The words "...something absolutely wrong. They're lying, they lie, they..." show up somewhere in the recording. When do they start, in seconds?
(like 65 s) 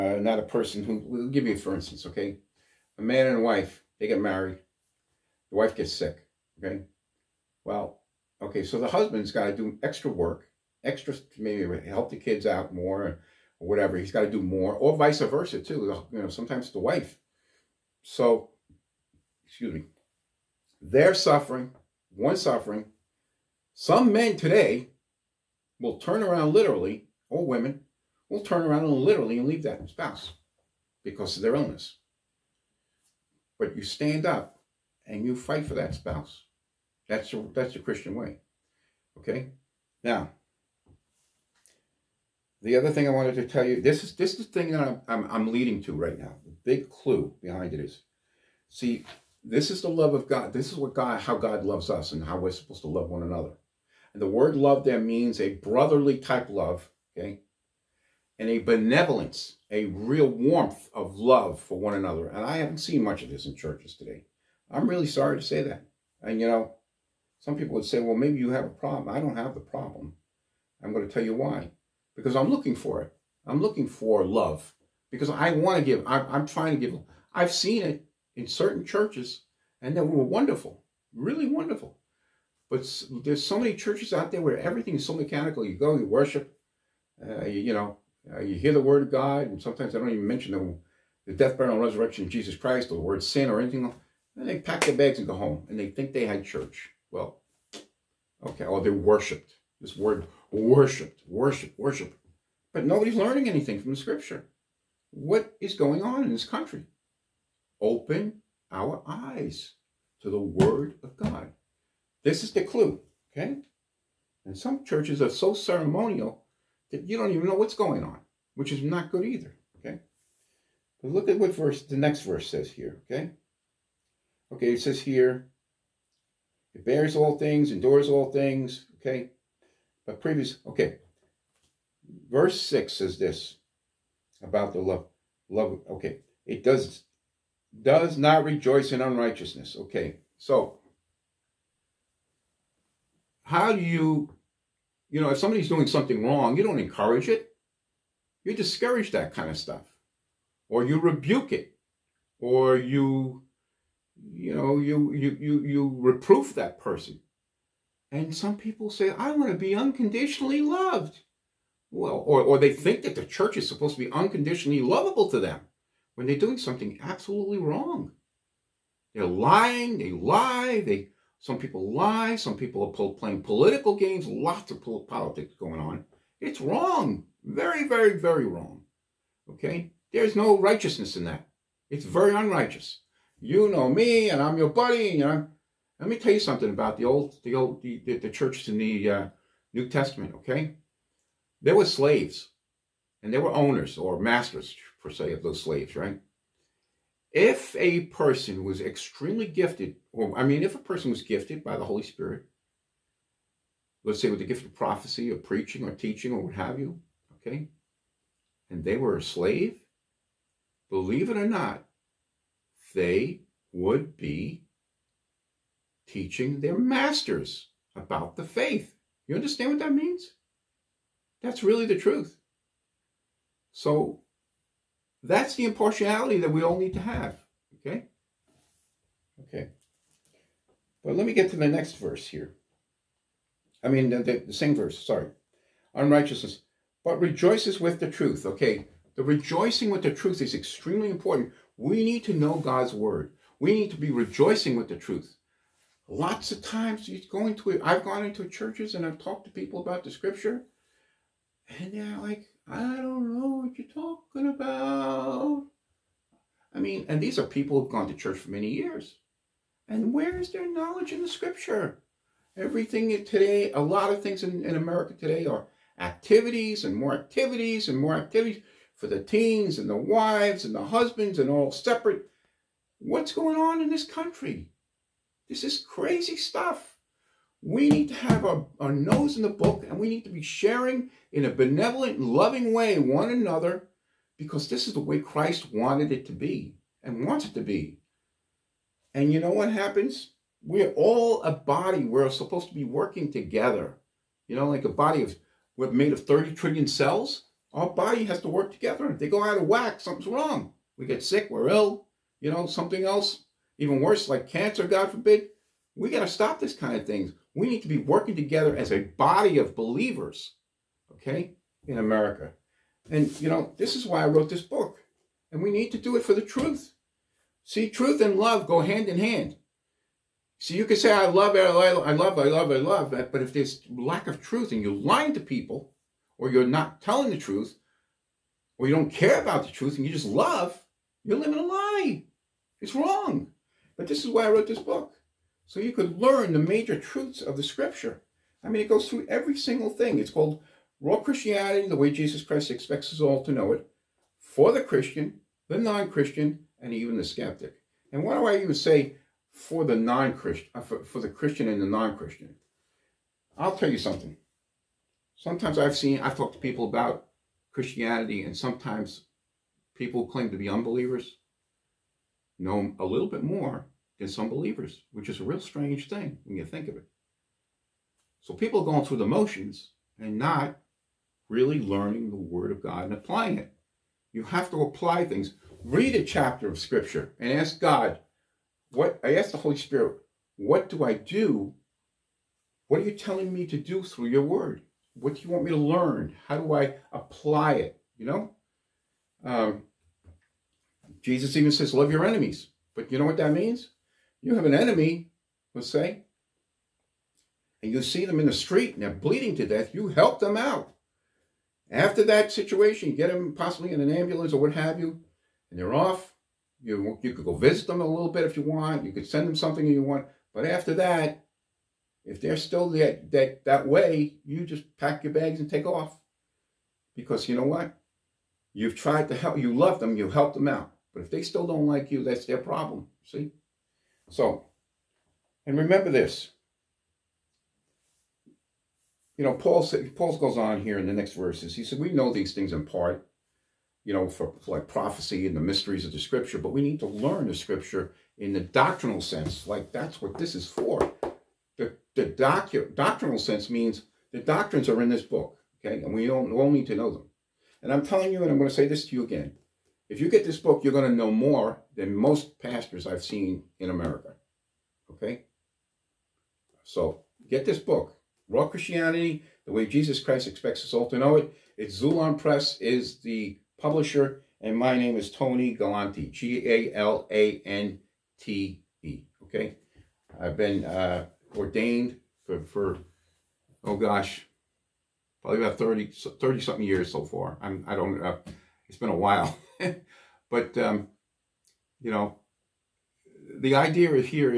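166 s.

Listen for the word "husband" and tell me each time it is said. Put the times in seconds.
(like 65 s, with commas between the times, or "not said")
8 s, 270 s.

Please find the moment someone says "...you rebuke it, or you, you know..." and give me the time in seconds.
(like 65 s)
150 s.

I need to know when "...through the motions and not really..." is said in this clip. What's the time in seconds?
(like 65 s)
369 s.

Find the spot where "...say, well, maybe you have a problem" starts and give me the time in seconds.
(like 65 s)
67 s.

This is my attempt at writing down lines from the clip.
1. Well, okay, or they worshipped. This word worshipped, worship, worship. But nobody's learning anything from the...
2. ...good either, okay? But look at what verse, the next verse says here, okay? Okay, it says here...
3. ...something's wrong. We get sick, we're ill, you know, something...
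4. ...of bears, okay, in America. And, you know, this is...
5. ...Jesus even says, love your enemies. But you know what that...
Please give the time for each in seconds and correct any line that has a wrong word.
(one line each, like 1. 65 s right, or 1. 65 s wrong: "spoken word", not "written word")
1. 97 s right
2. 119 s right
3. 300 s right
4. 309 s wrong: "believers", not "bears"
5. 391 s right.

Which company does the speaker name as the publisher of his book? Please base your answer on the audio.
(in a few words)
Xulon Press.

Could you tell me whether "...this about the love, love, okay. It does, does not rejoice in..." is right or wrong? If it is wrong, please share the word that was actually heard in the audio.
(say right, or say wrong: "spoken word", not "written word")
right.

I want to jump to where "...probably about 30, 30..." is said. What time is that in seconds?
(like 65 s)
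475 s.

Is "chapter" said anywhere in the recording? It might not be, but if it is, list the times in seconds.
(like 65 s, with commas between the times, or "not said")
376 s.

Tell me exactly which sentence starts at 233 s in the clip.
I mean, the, the, the same verse, sorry.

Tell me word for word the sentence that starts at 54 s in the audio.
And the word love there means a brotherly type love, okay?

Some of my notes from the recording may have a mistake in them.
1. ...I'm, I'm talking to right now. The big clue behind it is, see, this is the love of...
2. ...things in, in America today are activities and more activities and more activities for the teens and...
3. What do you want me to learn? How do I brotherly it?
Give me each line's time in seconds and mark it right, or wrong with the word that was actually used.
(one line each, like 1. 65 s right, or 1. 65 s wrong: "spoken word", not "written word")
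1. 45 s wrong: "leading", not "talking"
2. 264 s right
3. 385 s wrong: "apply", not "brotherly".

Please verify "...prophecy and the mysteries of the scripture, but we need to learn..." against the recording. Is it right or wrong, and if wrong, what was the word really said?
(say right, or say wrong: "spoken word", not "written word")
right.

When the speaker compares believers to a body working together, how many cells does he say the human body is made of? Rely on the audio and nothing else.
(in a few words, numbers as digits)
30 trillion.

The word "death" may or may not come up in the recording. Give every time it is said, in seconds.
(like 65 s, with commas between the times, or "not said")
91 s, 399 s.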